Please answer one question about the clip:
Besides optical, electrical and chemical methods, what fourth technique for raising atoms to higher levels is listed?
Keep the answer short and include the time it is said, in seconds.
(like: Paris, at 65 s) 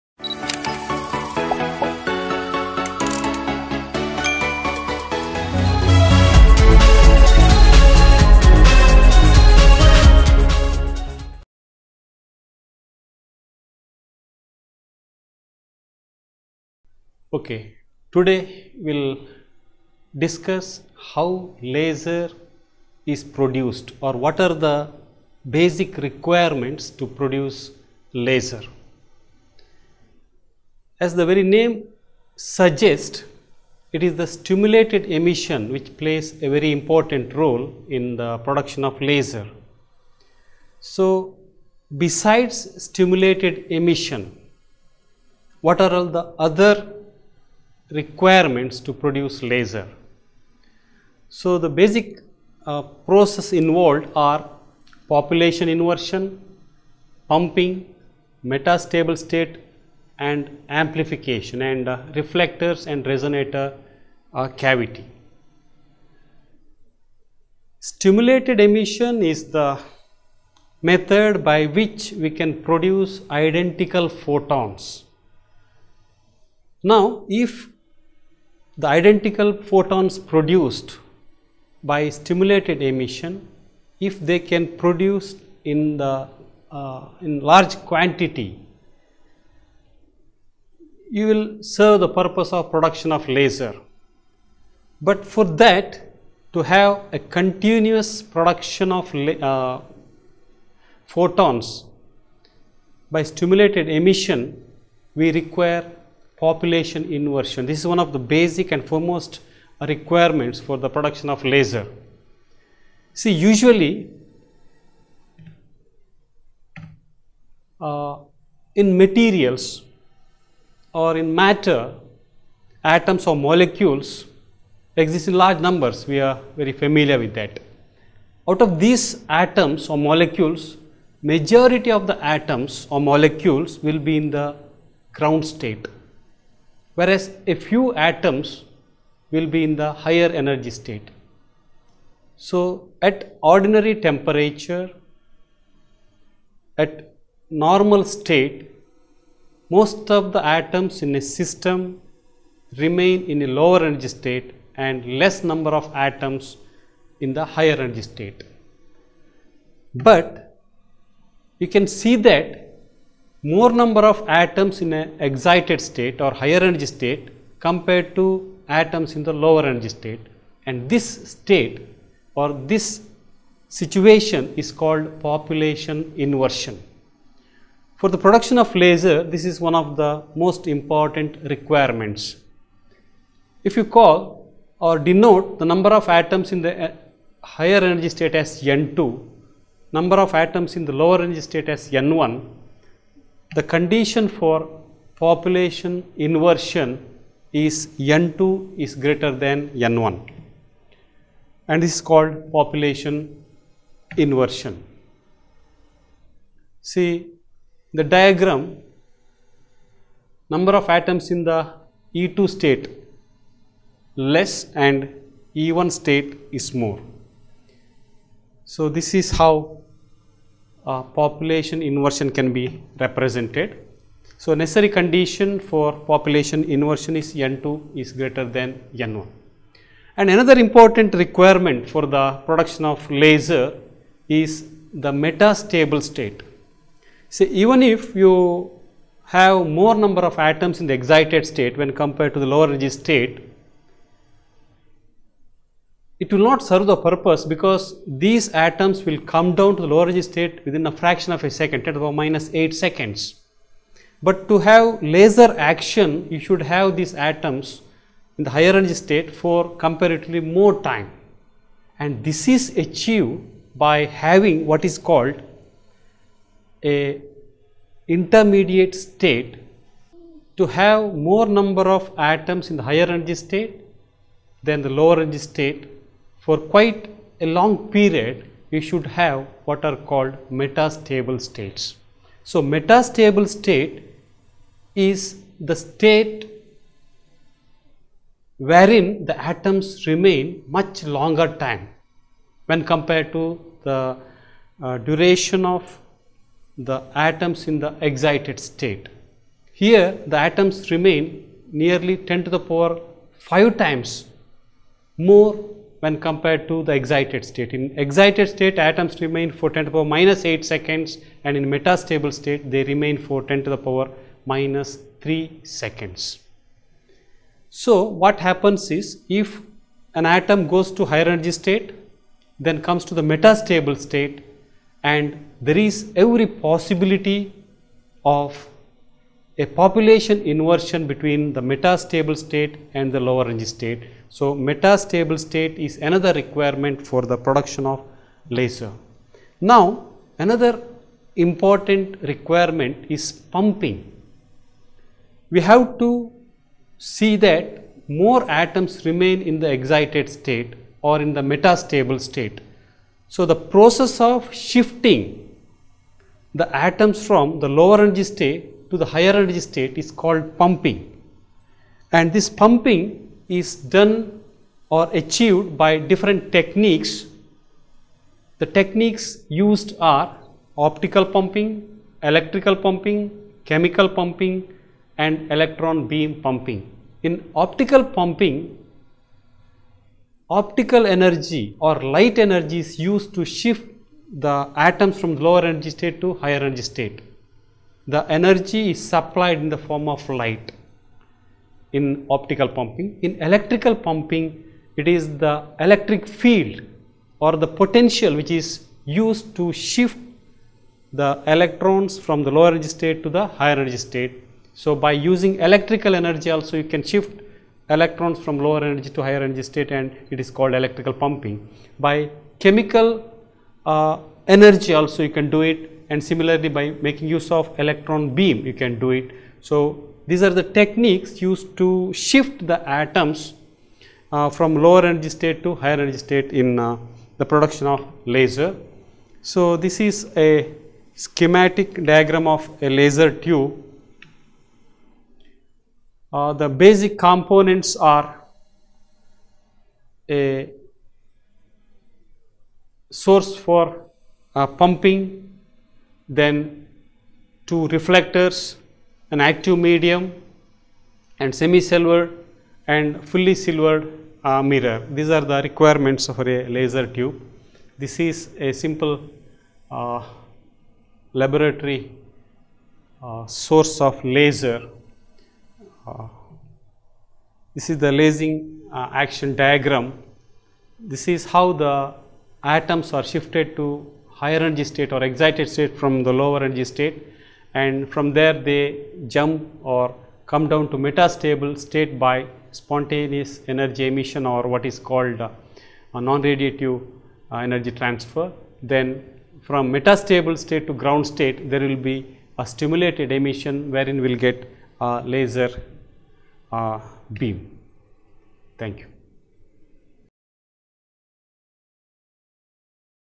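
Electron beam pumping, at 375 s.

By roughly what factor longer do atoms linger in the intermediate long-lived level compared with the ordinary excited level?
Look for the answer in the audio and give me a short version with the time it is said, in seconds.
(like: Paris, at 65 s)
10^5 times, at 302 s.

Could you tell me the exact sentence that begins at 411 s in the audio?
By chemical uh, energy also you can do it and similarly by making use of electron beam you can do it.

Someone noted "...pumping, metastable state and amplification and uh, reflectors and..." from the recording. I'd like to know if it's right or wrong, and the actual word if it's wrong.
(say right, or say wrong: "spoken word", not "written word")
right.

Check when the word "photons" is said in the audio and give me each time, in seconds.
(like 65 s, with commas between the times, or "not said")
74 s, 79 s, 101 s.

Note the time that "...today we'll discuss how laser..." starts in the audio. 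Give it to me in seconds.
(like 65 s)
18 s.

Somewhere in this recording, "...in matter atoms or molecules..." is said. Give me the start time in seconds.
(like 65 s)
121 s.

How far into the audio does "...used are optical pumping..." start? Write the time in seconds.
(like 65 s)
369 s.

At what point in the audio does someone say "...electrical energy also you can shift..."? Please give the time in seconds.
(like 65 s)
405 s.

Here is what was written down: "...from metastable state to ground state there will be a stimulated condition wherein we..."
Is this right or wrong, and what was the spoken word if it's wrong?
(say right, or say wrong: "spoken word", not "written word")
wrong: "emission", not "condition".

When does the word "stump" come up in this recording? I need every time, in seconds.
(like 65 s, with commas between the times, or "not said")
not said.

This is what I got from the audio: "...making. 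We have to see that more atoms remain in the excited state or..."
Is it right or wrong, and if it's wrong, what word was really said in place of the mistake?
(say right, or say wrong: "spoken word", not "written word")
wrong: "pumping", not "making".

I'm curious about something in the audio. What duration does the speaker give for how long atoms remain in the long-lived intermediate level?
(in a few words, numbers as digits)
10^-3 seconds.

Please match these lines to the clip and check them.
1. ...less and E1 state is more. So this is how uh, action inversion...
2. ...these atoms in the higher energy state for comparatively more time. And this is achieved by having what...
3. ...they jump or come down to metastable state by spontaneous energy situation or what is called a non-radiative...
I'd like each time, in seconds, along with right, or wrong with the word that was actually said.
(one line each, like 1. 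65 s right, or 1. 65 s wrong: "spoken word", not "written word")
1. 214 s wrong: "population", not "action"
2. 256 s right
3. 478 s wrong: "emission", not "situation".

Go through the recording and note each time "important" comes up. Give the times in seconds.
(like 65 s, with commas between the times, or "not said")
36 s, 180 s, 230 s, 341 s.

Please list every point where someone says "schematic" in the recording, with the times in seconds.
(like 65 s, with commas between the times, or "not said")
431 s.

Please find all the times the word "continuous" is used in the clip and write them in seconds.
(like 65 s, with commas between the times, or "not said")
97 s.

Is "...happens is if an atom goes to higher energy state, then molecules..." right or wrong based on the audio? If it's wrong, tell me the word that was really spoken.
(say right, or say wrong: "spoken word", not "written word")
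wrong: "comes", not "molecules".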